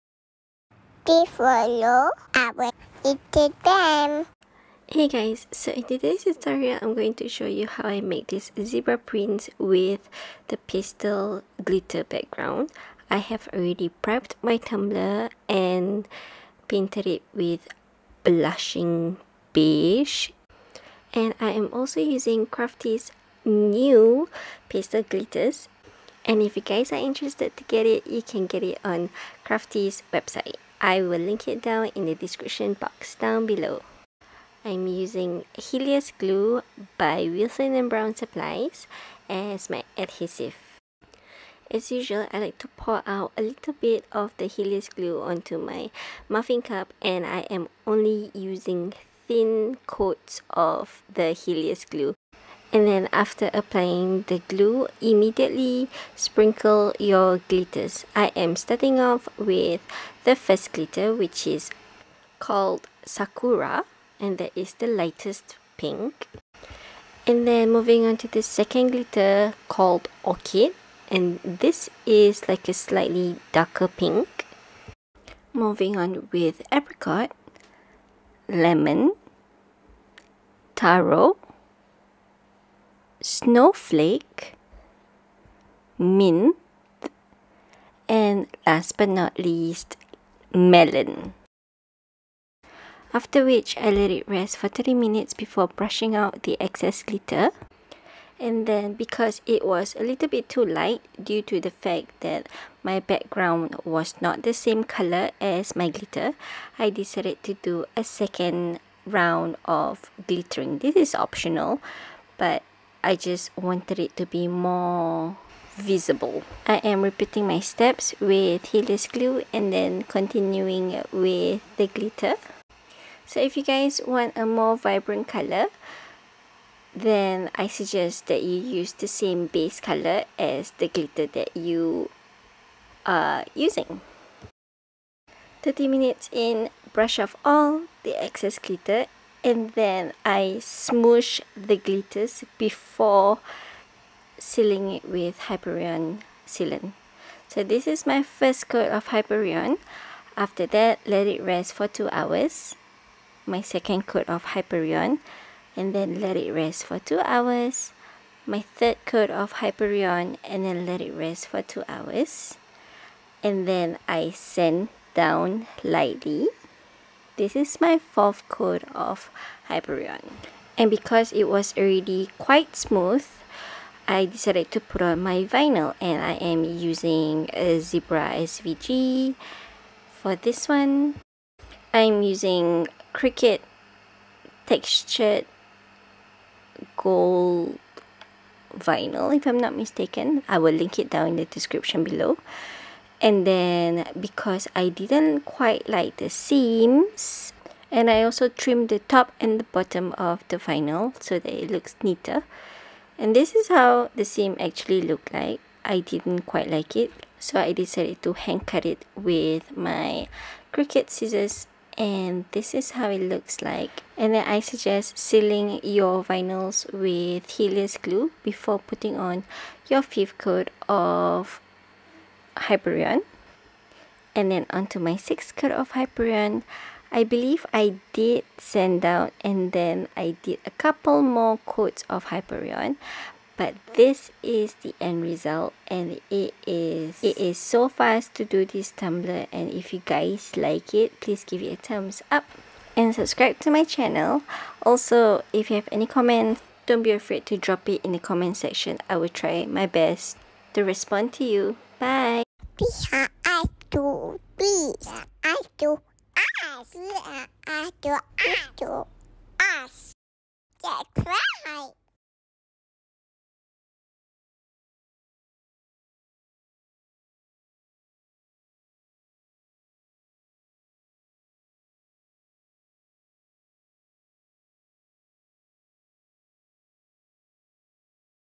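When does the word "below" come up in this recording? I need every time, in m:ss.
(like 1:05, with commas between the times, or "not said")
0:33, 3:12.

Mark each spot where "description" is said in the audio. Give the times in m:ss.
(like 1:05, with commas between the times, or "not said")
0:32, 3:11.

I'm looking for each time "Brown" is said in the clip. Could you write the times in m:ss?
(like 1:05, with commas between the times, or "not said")
0:37.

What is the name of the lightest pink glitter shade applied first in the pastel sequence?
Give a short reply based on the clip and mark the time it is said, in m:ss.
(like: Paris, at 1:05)
Sakura, at 1:03.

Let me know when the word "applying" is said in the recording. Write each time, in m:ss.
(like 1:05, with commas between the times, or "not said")
0:53.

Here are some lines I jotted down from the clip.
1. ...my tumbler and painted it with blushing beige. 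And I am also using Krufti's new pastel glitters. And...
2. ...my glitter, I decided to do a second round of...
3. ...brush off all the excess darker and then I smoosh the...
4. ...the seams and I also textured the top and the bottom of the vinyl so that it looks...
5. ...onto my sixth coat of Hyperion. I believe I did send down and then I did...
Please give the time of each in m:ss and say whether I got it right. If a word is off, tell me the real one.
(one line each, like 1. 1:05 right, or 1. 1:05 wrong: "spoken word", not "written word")
1. 0:14 right
2. 1:45 right
3. 2:16 wrong: "glitter", not "darker"
4. 3:16 wrong: "trimmed", not "textured"
5. 3:44 right.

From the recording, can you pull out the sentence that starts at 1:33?
After which, I let it rest for 30 minutes before brushing out the excess glitter.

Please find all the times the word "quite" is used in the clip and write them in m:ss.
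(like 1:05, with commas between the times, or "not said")
2:52, 3:15, 3:26.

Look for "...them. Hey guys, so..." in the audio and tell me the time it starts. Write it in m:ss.
0:03.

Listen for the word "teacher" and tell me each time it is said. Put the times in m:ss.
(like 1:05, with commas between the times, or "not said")
not said.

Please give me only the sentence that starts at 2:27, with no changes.
So this is my first coat of Hyperion.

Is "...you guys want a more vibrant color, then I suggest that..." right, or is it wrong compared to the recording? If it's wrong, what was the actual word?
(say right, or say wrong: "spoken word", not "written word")
right.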